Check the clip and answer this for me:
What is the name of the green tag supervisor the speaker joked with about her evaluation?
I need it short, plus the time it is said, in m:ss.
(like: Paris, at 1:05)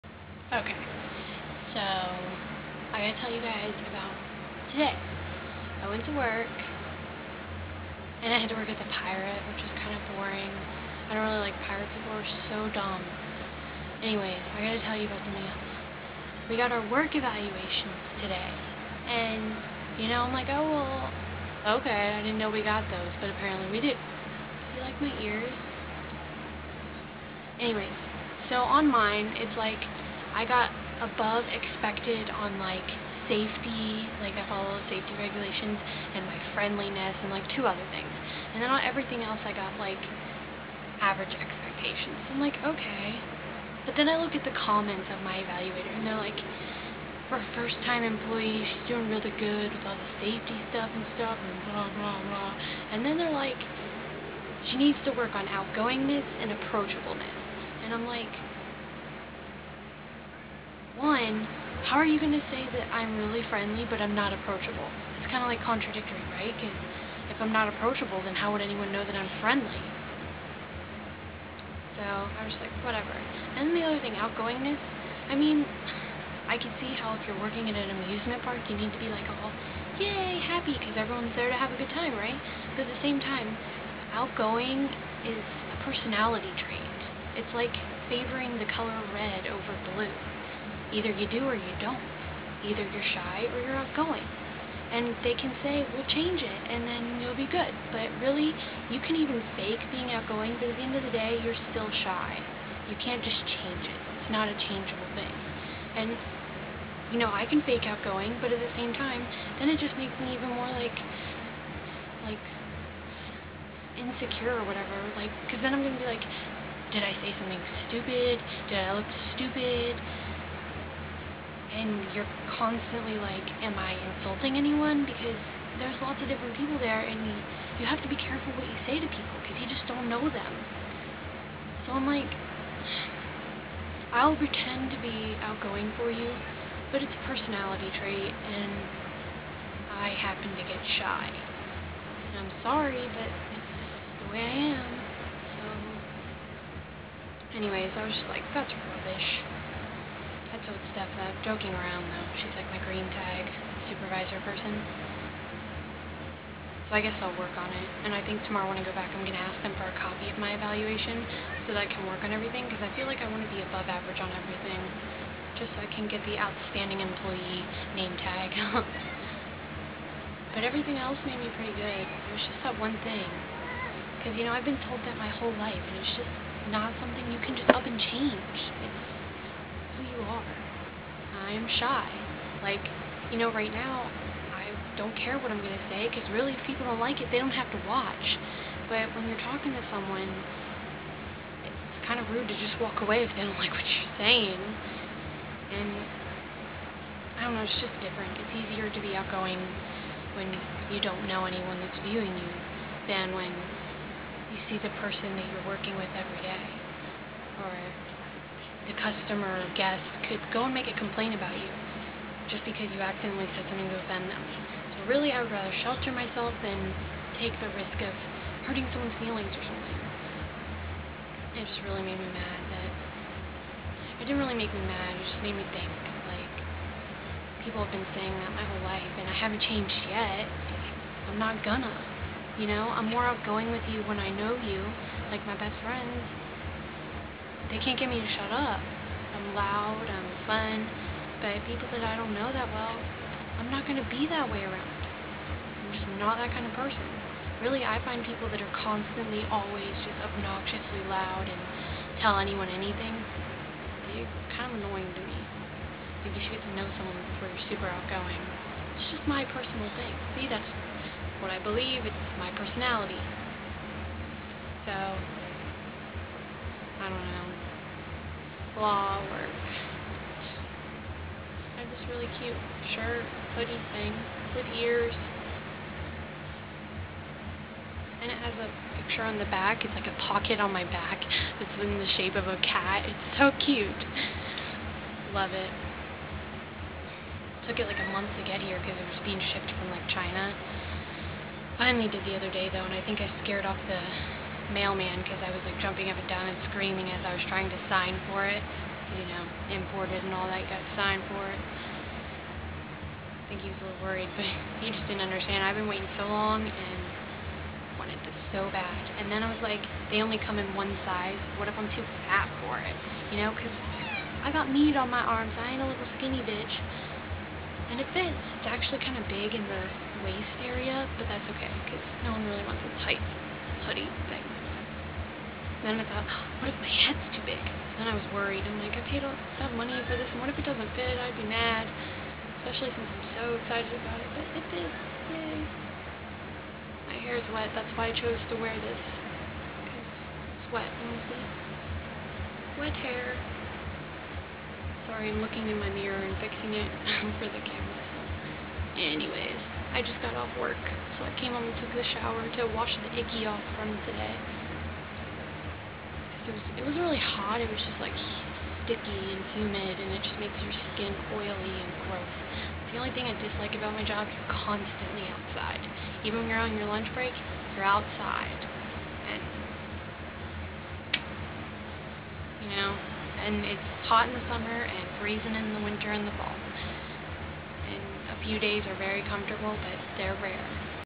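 Steph, at 2:30.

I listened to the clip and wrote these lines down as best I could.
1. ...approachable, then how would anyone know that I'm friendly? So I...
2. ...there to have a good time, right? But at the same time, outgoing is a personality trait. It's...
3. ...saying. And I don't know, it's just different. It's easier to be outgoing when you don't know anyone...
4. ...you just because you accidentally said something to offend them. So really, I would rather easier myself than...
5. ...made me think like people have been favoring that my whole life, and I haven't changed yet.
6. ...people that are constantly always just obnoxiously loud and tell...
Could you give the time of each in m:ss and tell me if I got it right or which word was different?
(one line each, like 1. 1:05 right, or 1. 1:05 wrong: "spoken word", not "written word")
1. 1:07 right
2. 1:21 right
3. 3:14 right
4. 3:31 wrong: "shelter", not "easier"
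5. 3:45 wrong: "saying", not "favoring"
6. 4:08 right.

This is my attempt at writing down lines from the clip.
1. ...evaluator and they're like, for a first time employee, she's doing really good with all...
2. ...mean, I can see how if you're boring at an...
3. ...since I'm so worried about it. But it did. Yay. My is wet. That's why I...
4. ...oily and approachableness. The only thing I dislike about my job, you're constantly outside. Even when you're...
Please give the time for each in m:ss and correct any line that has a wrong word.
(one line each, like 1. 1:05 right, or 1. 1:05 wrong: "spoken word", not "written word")
1. 0:45 right
2. 1:15 wrong: "working", not "boring"
3. 5:32 wrong: "excited", not "worried"
4. 6:01 wrong: "gross", not "approachableness".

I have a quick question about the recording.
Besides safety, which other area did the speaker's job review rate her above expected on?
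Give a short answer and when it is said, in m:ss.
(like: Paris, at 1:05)
friendliness, at 0:36.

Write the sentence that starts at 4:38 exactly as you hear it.
And it has a picture on the back.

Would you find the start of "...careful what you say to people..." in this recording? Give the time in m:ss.
2:08.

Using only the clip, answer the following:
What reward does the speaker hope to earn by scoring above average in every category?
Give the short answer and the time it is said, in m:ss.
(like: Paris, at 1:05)
outstanding employee name tag, at 2:46.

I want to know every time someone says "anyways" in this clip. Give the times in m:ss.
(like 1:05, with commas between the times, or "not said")
0:14, 0:27, 2:27, 5:49.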